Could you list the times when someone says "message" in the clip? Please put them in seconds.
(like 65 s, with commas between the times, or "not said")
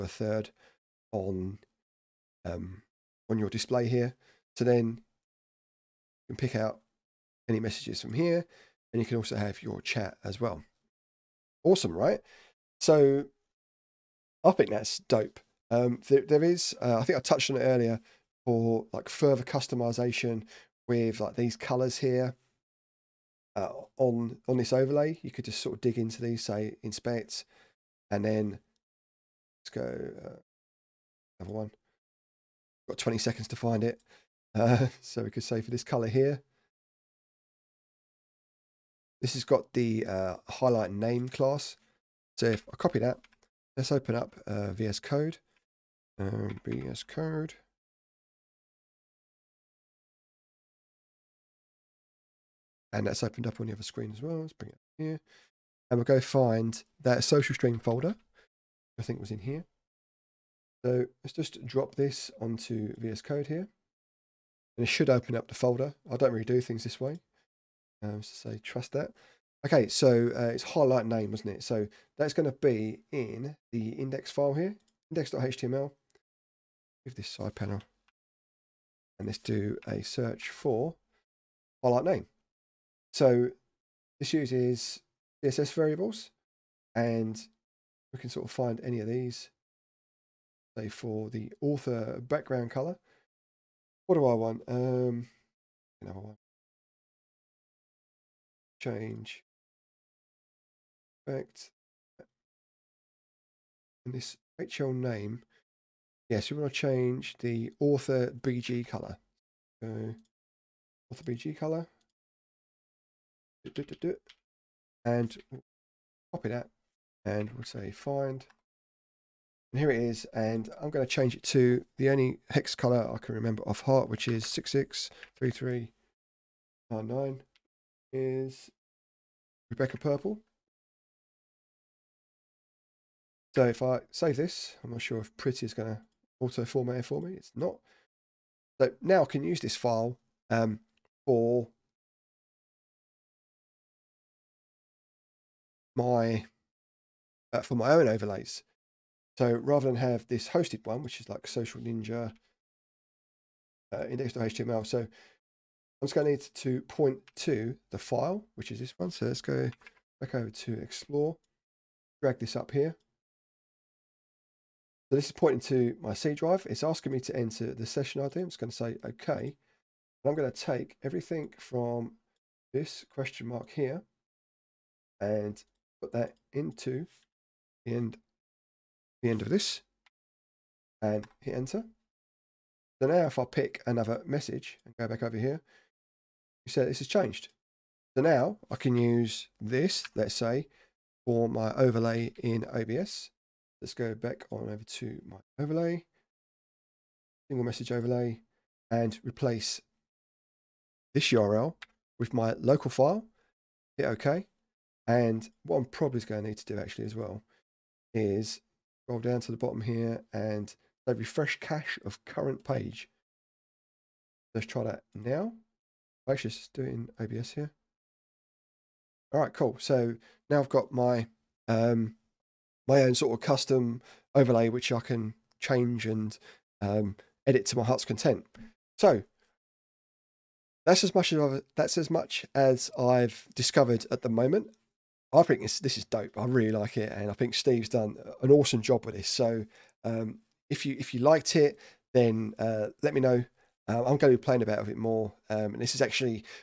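7 s, 184 s, 197 s.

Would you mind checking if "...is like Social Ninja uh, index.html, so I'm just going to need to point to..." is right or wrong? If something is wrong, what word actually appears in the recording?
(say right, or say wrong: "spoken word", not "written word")
right.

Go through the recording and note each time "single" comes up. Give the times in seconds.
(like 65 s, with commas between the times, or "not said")
197 s.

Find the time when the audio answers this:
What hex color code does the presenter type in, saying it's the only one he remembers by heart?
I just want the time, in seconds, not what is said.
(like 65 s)
124 s.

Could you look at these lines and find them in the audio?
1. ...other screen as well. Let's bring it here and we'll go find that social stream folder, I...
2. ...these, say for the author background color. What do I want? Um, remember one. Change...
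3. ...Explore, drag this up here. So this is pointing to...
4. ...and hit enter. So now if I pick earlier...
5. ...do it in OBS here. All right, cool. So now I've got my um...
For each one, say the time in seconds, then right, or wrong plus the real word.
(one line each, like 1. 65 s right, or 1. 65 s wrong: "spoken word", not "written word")
1. 53 s right
2. 89 s wrong: "another", not "remember"
3. 160 s right
4. 181 s wrong: "another", not "earlier"
5. 216 s right.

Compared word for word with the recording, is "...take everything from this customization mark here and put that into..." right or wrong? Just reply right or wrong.
wrong.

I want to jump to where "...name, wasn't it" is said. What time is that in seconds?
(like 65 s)
71 s.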